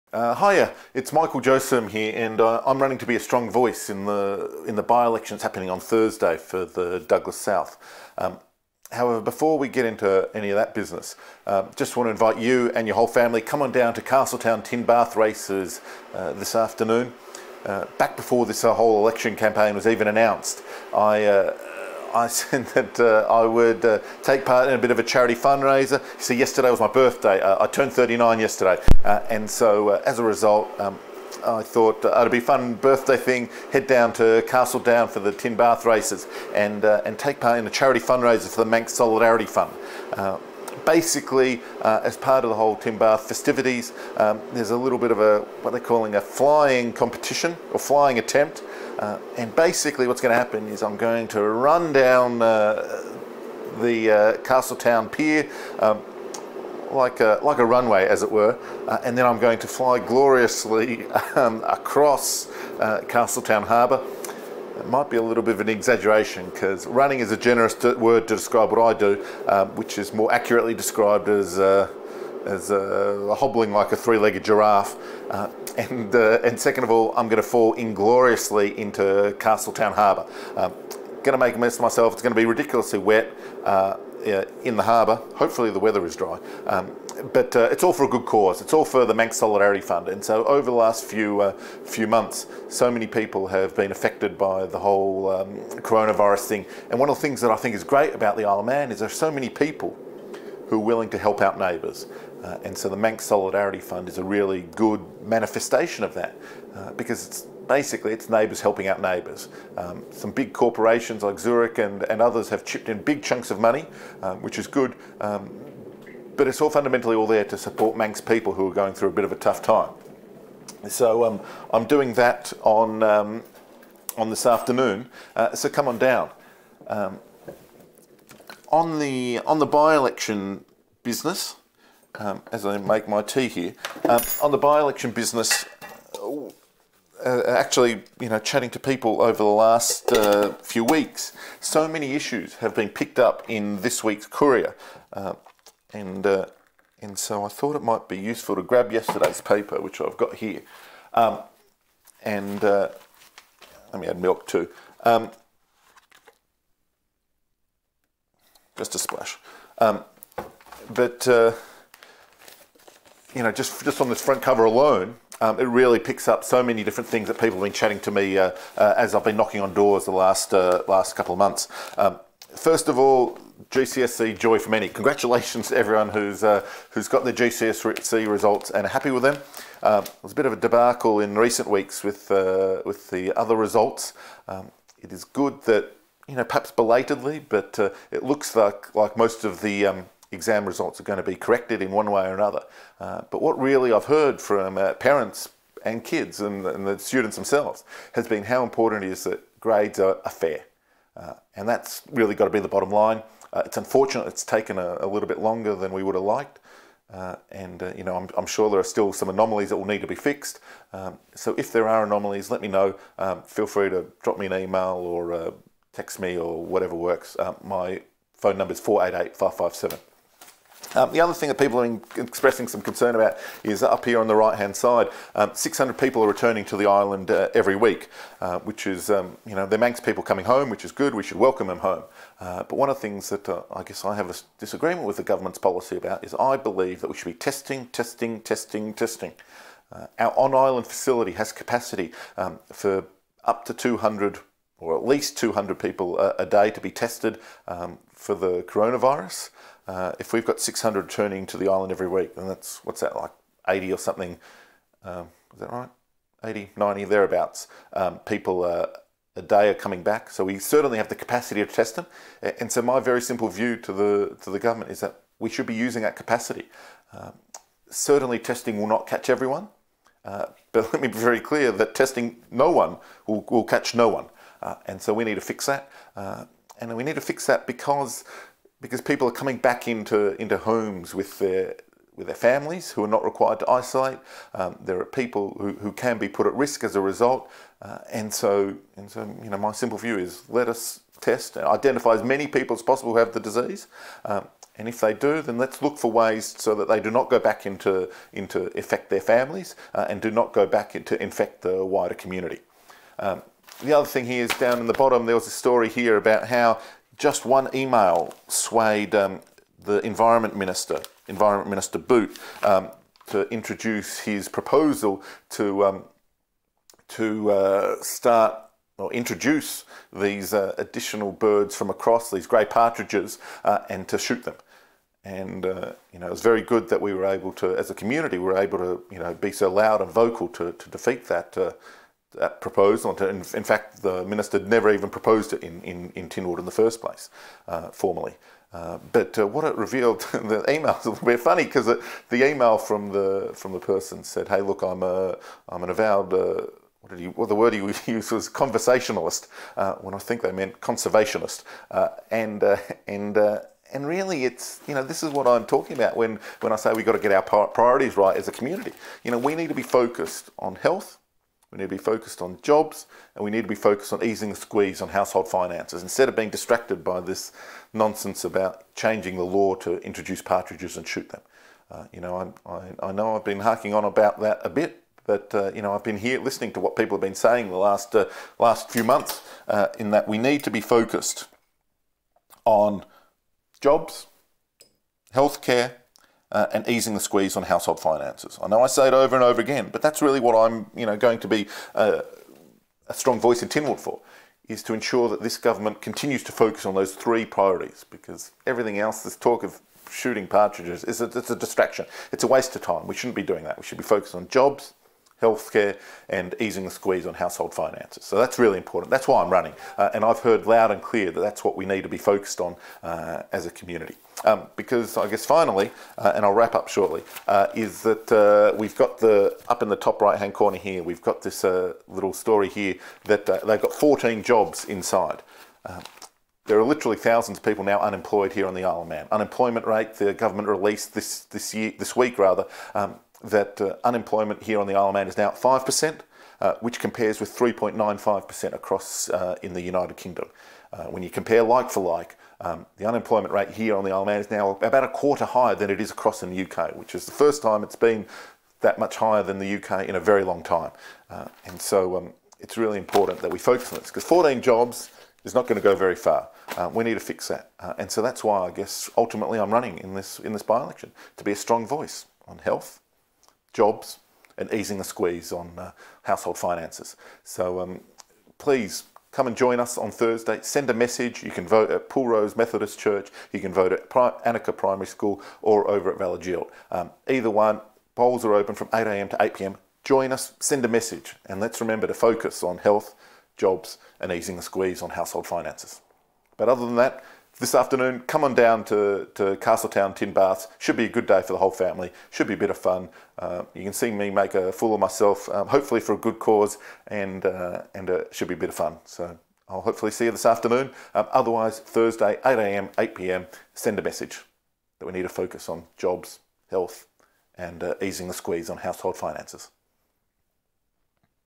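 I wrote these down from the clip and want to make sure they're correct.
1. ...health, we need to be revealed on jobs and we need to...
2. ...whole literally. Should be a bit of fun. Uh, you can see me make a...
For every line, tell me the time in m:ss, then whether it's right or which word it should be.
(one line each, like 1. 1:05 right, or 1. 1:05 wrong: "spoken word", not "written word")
1. 6:00 wrong: "focused", not "revealed"
2. 8:11 wrong: "family", not "literally".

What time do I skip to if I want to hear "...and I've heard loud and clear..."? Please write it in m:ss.
6:50.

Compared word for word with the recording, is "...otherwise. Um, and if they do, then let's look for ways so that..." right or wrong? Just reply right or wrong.
wrong.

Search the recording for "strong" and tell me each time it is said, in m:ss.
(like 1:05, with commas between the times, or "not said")
0:03, 6:33, 7:41.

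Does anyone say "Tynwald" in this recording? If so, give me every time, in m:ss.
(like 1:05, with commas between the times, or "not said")
5:36, 6:33.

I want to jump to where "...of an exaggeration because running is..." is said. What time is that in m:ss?
1:05.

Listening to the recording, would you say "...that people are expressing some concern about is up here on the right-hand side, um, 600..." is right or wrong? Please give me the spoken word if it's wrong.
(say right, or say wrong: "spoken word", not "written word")
right.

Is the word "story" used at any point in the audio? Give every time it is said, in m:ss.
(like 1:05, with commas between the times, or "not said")
5:05, 7:02.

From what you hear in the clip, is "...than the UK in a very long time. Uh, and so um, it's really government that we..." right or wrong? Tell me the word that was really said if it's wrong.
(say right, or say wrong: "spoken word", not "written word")
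wrong: "important", not "government".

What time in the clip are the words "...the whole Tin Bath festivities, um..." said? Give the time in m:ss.
0:42.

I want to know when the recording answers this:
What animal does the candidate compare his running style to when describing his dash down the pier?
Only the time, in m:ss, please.
1:13.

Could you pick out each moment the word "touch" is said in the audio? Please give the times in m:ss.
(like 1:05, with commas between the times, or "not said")
not said.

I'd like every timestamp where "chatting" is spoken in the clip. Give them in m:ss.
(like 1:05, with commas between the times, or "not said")
2:18, 2:47.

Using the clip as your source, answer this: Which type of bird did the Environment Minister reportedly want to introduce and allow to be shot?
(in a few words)
grey partridges.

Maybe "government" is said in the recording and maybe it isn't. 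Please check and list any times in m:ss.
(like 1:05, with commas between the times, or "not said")
3:55, 4:24, 6:35, 7:10.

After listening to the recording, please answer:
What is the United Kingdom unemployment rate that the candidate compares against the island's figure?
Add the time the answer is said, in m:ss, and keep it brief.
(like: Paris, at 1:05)
3.95%, at 7:17.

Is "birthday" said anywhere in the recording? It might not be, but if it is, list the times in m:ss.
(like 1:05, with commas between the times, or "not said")
0:26, 0:32.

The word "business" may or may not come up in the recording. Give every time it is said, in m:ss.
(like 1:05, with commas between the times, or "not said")
0:10, 2:11, 2:15.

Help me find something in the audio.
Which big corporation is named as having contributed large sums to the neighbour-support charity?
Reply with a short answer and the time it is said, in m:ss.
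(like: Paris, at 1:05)
Zurich, at 1:51.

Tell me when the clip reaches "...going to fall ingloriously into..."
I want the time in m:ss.
1:17.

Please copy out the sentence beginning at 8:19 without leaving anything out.
So I'll hopefully see you this afternoon.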